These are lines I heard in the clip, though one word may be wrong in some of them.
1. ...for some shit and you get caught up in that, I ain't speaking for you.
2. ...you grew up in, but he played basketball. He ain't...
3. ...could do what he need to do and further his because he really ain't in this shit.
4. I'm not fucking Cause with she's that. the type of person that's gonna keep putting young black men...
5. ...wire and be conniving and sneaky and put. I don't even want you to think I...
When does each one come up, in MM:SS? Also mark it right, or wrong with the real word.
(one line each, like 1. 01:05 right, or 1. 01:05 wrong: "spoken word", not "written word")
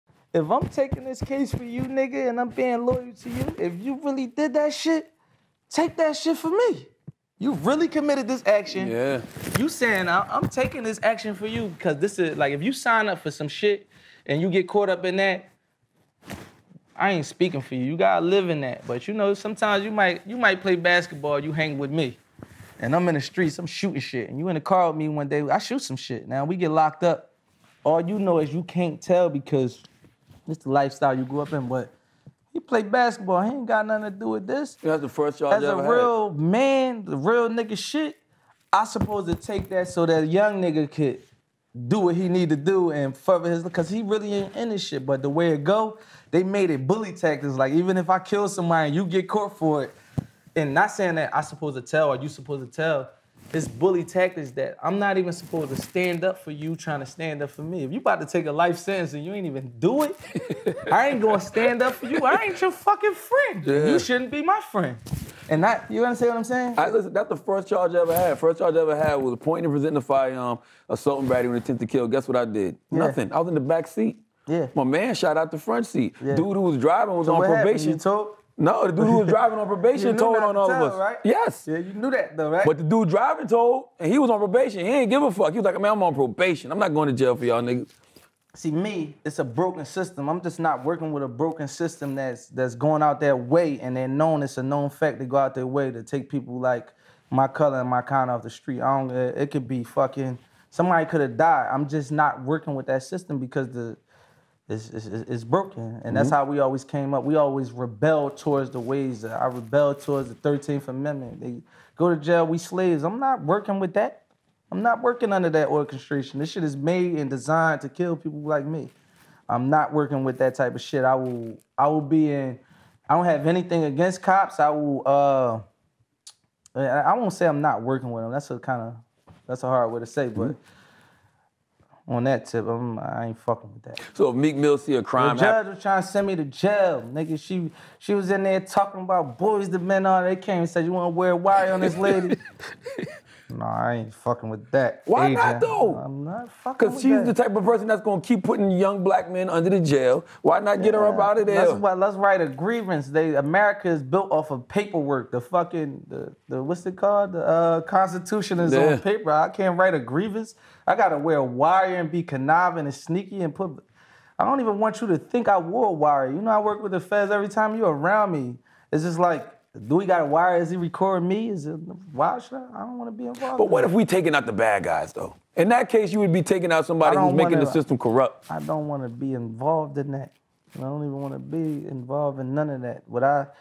1. 00:13 right
2. 00:31 right
3. 00:40 right
4. 02:25 right
5. 02:41 right.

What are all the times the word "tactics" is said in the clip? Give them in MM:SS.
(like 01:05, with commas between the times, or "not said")
00:47, 00:54.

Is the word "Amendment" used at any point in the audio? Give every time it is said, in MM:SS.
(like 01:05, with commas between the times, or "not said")
01:50.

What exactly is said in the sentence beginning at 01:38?
I don't it could be fucking somebody could have died.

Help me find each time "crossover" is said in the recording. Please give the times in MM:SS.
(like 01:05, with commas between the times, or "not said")
not said.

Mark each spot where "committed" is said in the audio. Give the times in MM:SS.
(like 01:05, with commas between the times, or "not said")
00:07.